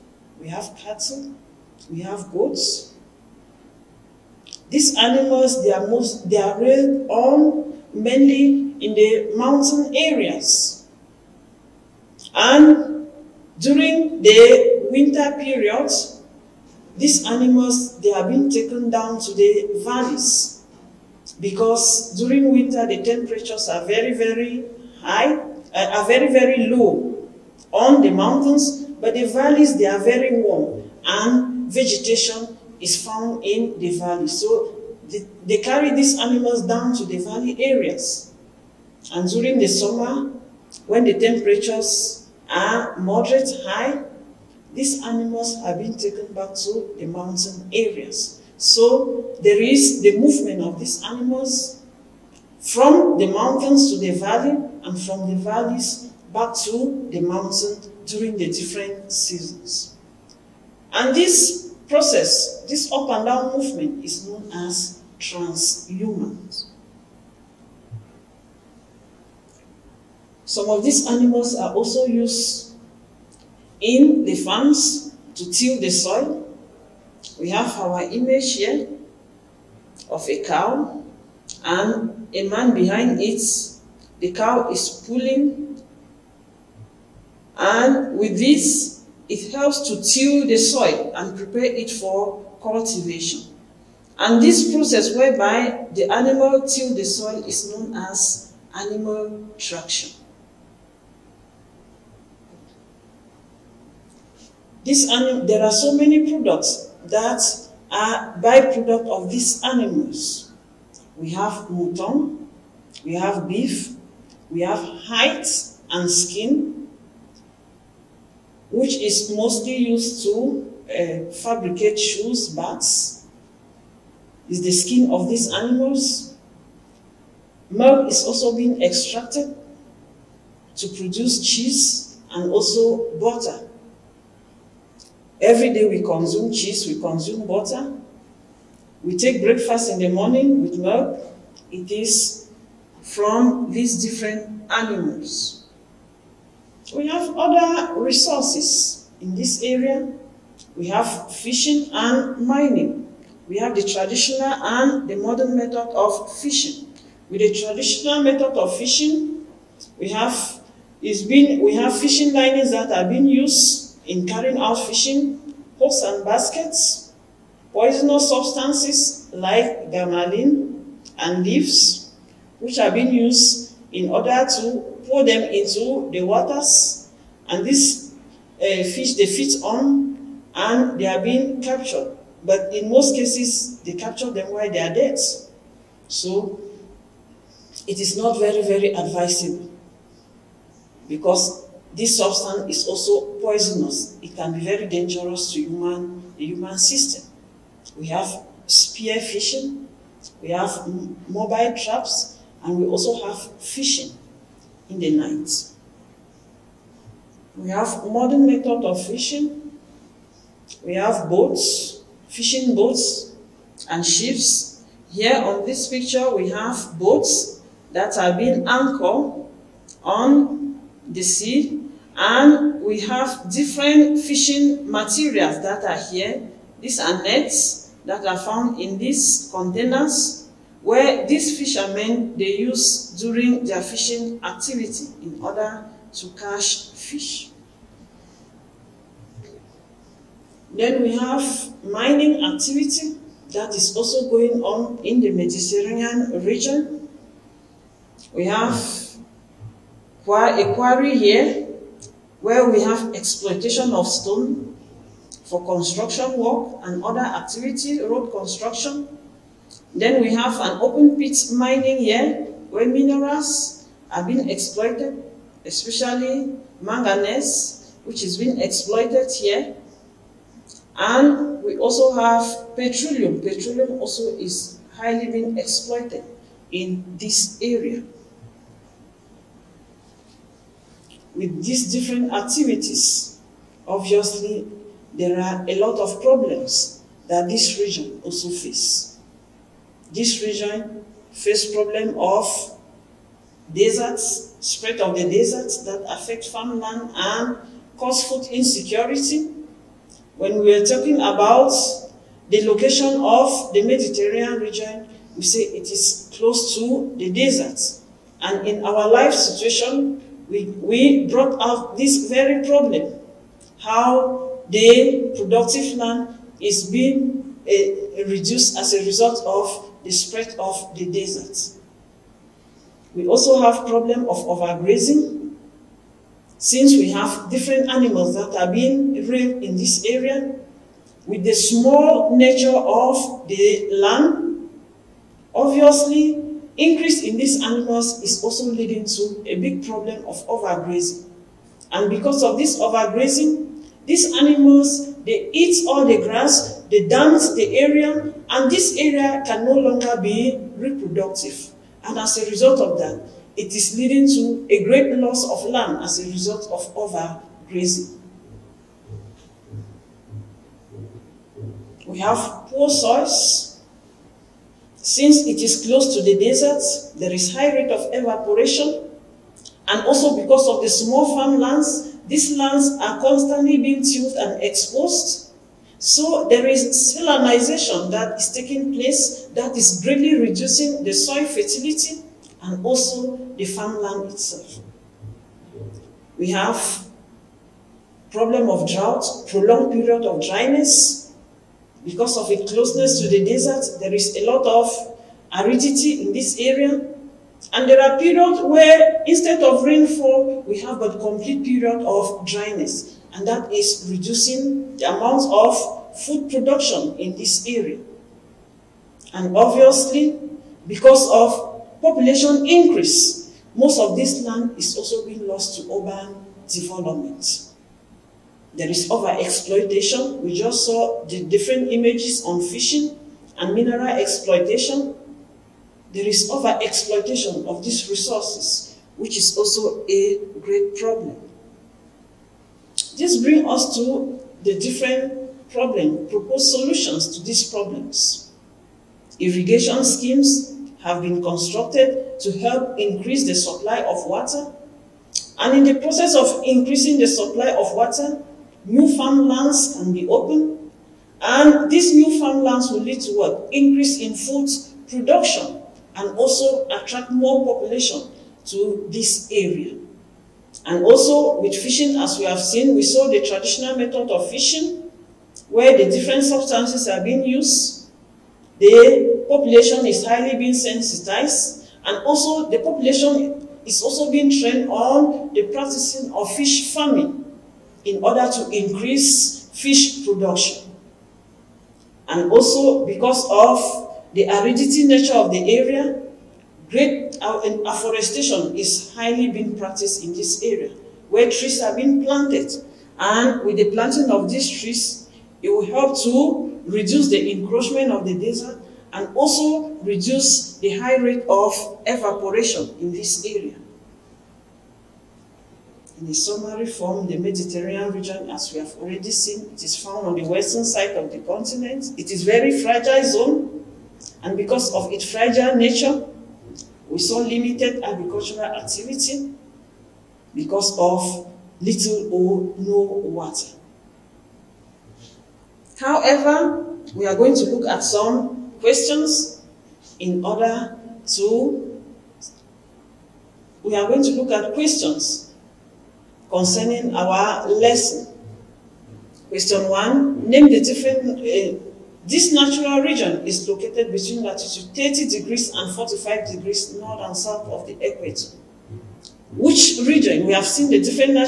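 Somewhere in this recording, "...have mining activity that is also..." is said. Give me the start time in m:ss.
4:01.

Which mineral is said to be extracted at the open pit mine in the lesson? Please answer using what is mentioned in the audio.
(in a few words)
manganese.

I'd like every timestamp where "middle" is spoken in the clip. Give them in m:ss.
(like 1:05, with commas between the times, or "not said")
not said.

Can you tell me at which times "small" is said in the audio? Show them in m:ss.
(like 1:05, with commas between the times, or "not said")
5:31, 6:10.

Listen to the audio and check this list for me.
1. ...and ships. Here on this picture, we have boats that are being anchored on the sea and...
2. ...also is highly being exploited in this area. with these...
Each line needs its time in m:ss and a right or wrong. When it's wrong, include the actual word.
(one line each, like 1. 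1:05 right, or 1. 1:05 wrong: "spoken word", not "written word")
1. 3:33 right
2. 4:34 right.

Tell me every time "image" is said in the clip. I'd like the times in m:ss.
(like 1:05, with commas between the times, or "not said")
1:18, 7:01.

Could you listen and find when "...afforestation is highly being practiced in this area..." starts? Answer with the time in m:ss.
8:07.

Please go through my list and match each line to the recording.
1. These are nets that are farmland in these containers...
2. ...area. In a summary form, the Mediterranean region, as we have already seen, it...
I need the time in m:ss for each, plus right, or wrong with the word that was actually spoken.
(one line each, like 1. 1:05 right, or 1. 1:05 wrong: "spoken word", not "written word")
1. 3:46 wrong: "found", not "farmland"
2. 8:23 right.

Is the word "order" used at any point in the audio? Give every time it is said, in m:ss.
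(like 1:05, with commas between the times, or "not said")
2:54, 3:55, 7:58, 8:50.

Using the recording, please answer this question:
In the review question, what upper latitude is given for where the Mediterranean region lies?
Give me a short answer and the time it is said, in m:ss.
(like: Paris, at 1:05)
45 degrees, at 9:05.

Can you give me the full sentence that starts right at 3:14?
It can be very dangerous to human, the human system.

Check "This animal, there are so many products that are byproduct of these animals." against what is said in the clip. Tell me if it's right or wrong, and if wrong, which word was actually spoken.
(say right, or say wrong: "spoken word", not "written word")
right.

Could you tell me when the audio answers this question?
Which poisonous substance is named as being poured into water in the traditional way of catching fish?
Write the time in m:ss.
2:49.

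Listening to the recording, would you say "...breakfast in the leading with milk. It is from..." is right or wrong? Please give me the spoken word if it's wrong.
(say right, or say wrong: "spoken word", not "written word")
wrong: "morning", not "leading".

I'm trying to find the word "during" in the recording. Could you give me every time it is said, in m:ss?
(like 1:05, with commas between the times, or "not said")
0:13, 0:22, 0:39, 0:58, 3:53.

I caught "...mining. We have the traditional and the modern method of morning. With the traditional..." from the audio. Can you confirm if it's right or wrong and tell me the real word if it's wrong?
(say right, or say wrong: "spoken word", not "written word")
wrong: "fishing", not "morning".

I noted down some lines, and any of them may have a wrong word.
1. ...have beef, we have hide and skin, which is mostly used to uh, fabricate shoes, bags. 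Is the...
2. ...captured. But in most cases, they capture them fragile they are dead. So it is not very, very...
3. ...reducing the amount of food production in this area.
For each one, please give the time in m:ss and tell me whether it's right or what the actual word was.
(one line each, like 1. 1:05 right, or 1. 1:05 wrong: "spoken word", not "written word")
1. 1:53 right
2. 3:01 wrong: "while", not "fragile"
3. 6:44 right.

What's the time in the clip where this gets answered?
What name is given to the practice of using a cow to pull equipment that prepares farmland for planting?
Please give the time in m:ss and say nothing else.
1:38.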